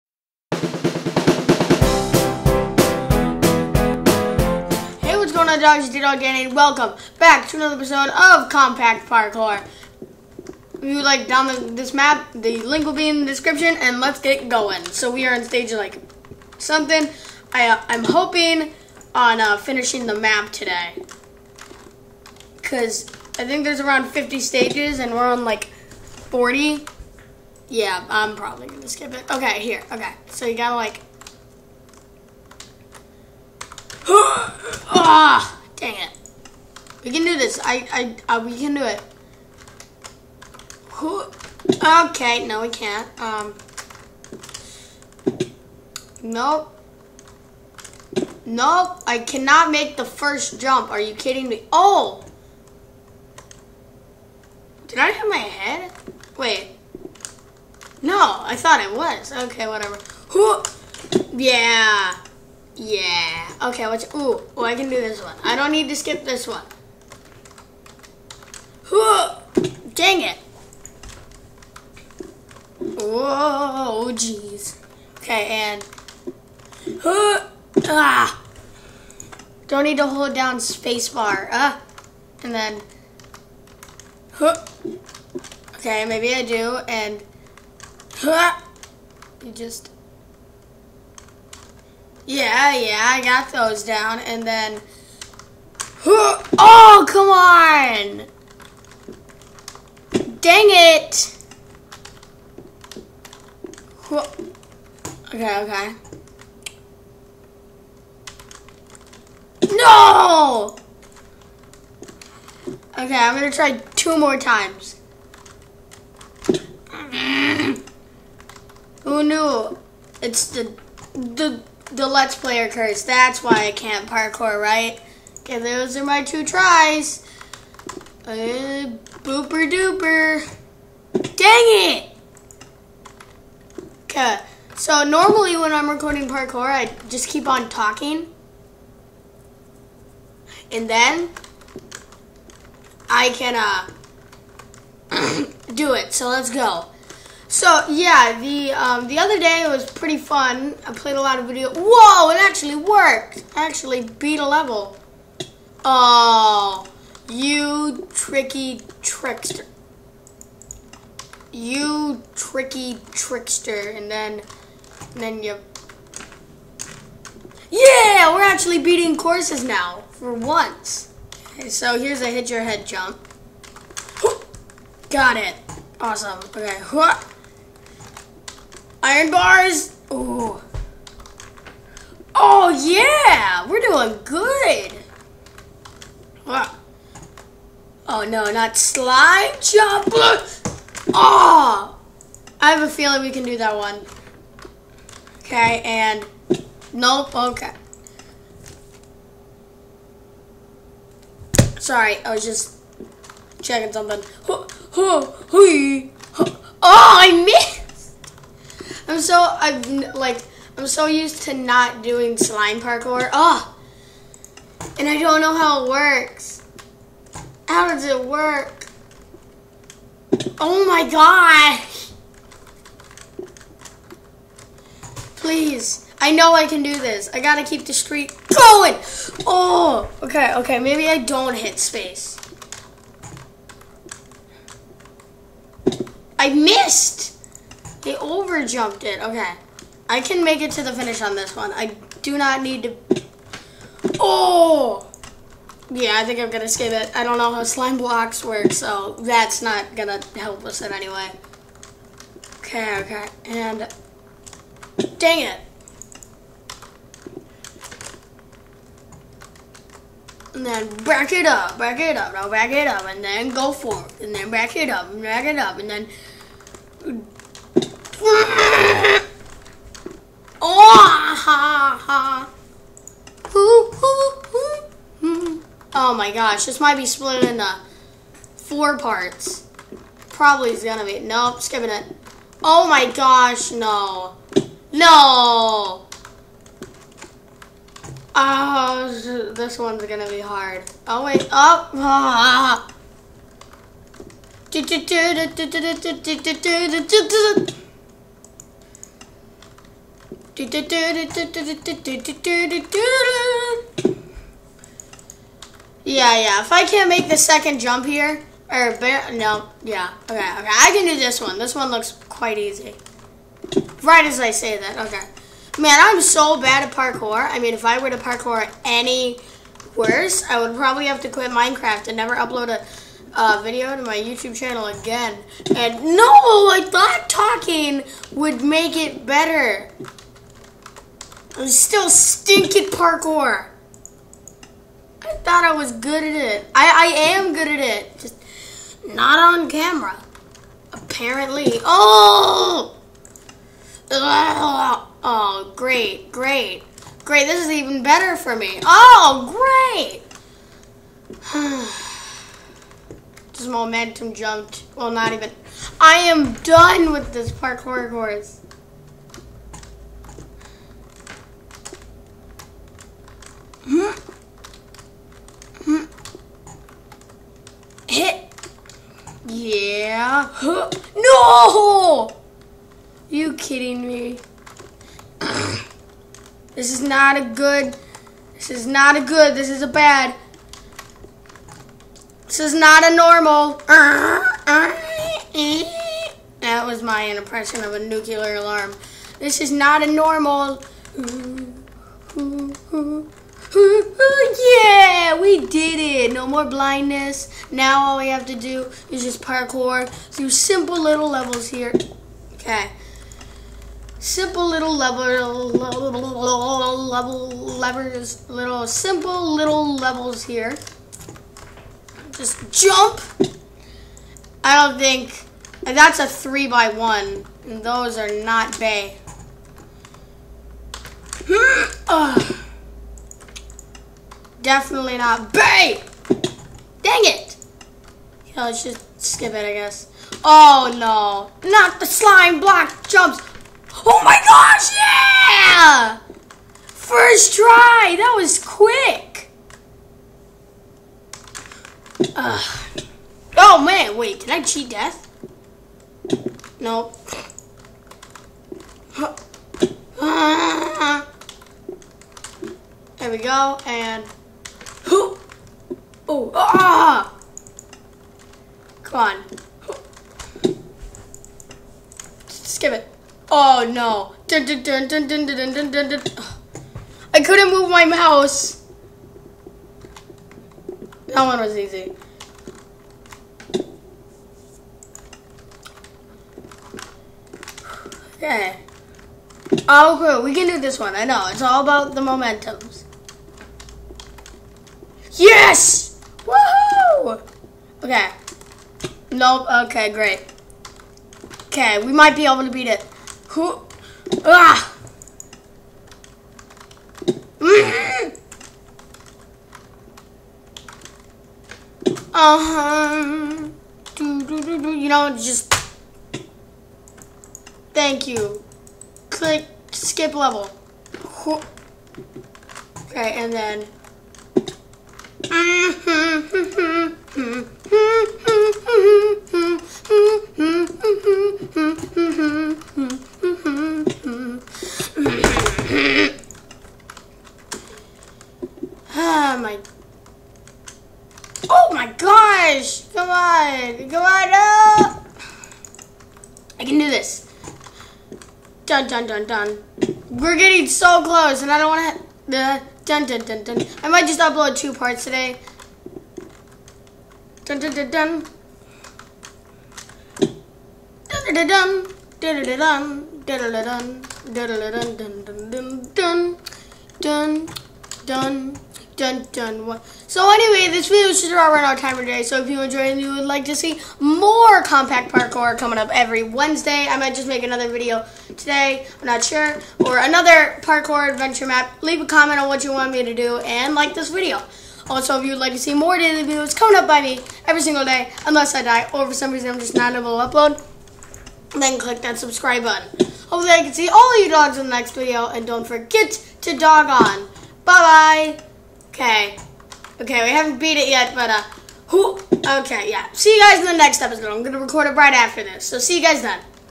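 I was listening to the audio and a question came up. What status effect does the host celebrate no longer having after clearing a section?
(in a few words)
Blindness.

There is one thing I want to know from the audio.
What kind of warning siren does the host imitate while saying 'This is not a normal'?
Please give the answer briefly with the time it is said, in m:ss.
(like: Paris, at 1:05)
Nuclear alarm, at 6:27.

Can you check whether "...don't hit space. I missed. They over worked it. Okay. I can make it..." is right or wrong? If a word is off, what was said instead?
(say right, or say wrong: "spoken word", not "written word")
wrong: "jumped", not "worked".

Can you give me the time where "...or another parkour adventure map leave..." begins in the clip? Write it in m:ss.
9:29.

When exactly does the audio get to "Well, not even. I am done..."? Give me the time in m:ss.
5:54.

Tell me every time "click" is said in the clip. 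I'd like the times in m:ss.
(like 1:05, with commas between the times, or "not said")
8:29, 9:41.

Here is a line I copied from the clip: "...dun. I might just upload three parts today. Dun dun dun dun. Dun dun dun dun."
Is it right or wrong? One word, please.
wrong.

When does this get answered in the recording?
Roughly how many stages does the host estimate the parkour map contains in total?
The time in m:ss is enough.
0:24.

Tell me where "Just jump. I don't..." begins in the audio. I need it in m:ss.
6:52.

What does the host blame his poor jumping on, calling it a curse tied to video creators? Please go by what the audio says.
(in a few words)
The Let's Player curse.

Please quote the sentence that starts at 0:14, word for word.
So we are on stage like something.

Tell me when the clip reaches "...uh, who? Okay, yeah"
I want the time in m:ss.
9:51.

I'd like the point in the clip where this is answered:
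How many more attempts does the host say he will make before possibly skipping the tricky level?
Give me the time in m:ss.
1:53.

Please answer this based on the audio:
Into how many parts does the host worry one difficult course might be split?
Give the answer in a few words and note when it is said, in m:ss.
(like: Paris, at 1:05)
4, at 4:38.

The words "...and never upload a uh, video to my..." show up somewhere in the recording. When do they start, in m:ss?
5:22.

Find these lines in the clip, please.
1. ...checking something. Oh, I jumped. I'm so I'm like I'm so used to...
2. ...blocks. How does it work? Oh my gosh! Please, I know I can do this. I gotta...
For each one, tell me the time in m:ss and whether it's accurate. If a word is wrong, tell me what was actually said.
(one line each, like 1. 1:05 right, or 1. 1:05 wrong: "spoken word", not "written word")
1. 3:23 wrong: "missed", not "jumped"
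2. 3:35 wrong: "works", not "blocks".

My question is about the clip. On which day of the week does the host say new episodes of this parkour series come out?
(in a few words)
Wednesday.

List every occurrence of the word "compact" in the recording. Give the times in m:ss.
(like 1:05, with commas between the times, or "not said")
0:08, 9:24.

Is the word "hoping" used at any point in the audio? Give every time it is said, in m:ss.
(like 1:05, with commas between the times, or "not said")
0:18.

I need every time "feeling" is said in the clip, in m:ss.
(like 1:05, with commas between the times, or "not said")
3:12.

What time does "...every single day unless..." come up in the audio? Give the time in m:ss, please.
9:37.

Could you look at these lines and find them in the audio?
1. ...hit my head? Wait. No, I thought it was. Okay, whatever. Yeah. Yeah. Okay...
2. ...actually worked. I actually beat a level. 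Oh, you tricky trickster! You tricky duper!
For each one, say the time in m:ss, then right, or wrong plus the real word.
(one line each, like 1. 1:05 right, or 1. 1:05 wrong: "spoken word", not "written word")
1. 0:55 right
2. 2:32 wrong: "trickster", not "duper".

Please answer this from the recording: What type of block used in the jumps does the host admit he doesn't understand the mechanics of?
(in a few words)
Slime blocks.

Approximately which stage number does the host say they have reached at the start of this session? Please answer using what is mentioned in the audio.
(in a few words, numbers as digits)
40.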